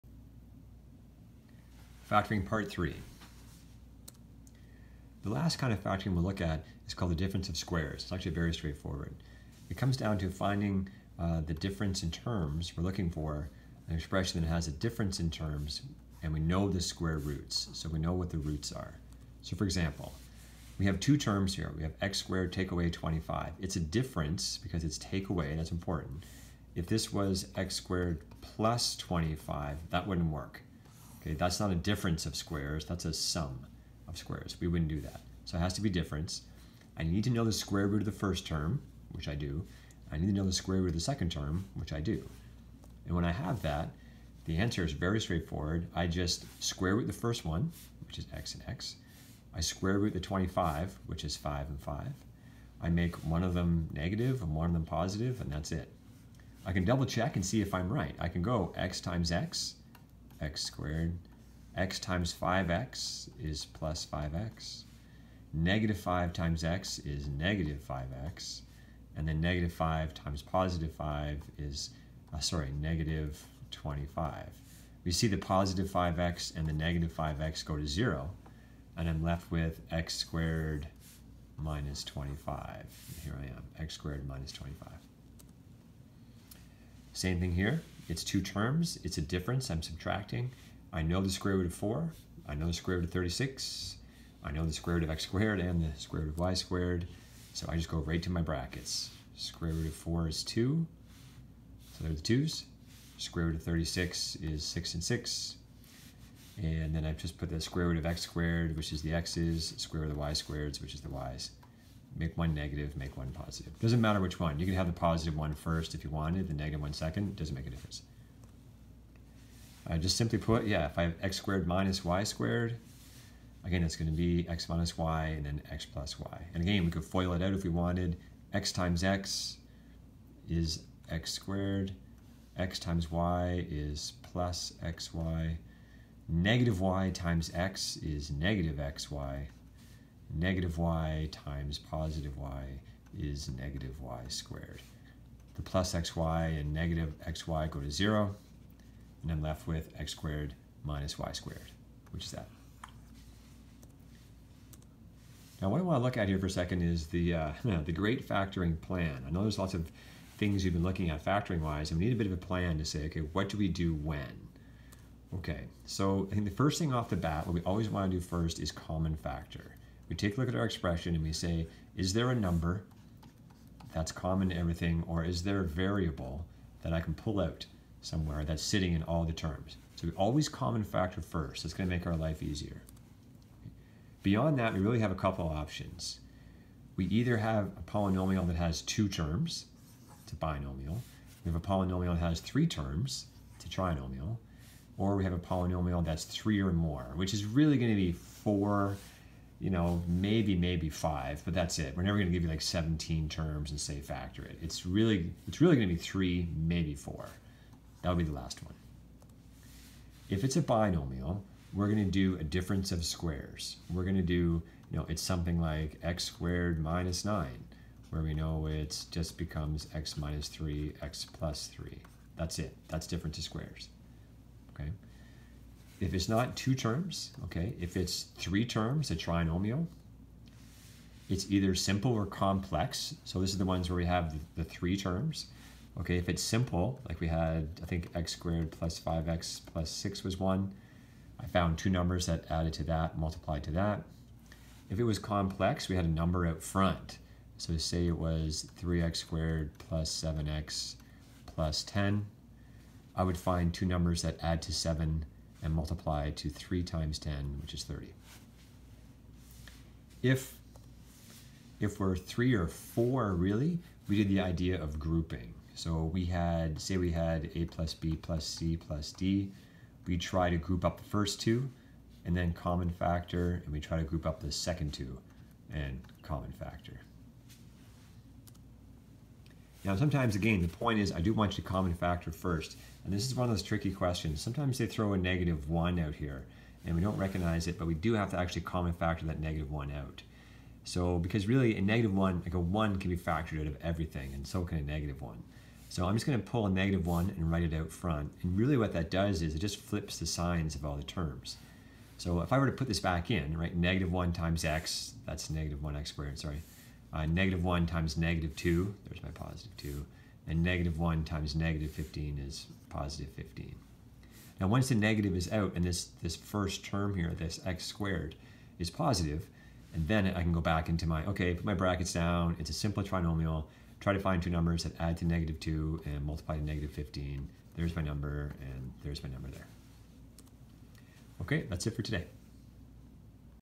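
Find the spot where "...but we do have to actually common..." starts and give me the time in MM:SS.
04:47.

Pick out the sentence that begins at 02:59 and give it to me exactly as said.
So we always common factor first.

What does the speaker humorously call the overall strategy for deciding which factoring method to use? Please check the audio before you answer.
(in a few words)
the great factoring plan.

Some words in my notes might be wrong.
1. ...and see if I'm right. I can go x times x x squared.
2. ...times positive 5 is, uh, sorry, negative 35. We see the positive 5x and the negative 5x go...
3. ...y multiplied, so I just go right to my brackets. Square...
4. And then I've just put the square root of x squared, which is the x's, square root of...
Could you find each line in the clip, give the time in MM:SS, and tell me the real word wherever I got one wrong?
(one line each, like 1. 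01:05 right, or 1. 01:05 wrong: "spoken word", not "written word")
1. 00:57 right
2. 01:10 wrong: "25", not "35"
3. 01:36 wrong: "squared", not "multiplied"
4. 01:46 right.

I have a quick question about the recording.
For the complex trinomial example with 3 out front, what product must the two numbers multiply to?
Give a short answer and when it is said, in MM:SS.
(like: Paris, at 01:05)
30, at 04:17.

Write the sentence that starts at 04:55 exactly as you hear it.
So I'm just going to pull a negative 1 and write it out front.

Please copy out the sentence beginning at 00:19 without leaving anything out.
So for example, we have two terms here.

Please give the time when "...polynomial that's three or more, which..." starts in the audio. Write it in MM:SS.
03:15.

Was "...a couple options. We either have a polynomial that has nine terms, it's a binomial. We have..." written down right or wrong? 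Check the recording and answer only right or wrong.
wrong.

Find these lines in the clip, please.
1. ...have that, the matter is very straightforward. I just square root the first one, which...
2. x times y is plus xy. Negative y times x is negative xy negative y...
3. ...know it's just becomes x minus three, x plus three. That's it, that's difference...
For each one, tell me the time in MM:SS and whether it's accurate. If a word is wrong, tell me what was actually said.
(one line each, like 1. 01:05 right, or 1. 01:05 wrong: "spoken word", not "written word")
1. 00:43 wrong: "answer", not "matter"
2. 02:12 right
3. 03:38 right.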